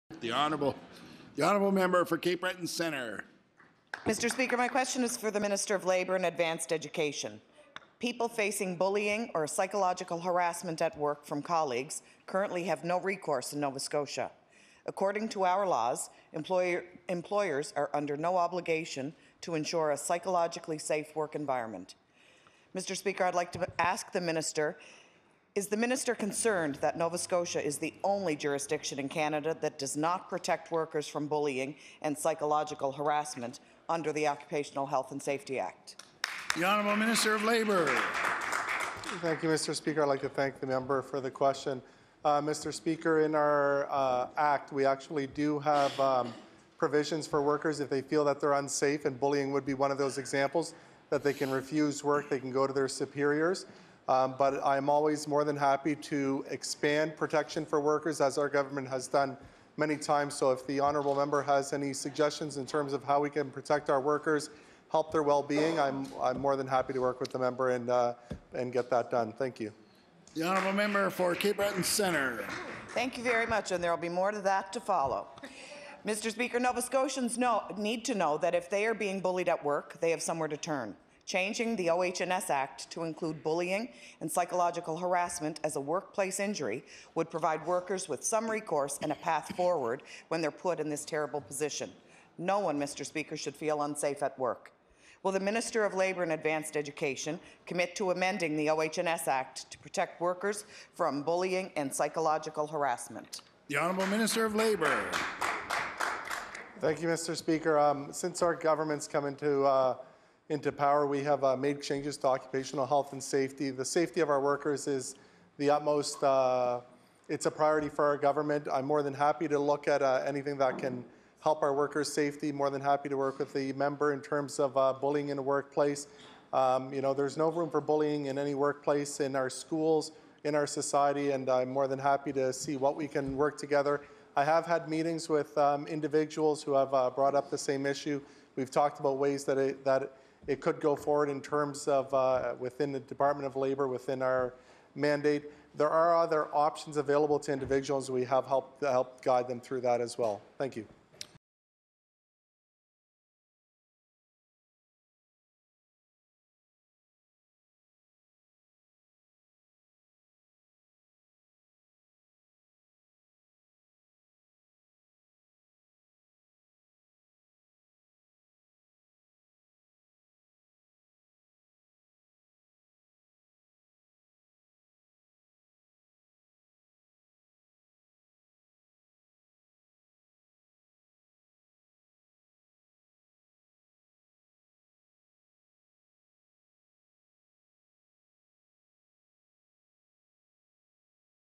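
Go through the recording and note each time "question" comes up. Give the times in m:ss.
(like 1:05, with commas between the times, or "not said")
0:04, 0:41.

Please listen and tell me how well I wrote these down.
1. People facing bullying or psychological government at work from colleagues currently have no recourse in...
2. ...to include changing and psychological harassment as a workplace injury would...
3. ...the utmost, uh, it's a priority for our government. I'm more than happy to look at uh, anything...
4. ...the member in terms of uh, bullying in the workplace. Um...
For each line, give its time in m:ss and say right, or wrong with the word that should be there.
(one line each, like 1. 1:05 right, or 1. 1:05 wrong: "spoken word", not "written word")
1. 0:07 wrong: "harassment", not "government"
2. 1:22 wrong: "bullying", not "changing"
3. 1:55 right
4. 2:03 right.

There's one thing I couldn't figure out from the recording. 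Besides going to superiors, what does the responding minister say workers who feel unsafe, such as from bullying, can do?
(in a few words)
refuse work.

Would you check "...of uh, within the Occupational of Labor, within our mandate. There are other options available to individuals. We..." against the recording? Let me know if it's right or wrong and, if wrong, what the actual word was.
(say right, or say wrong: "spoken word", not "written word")
wrong: "Department", not "Occupational".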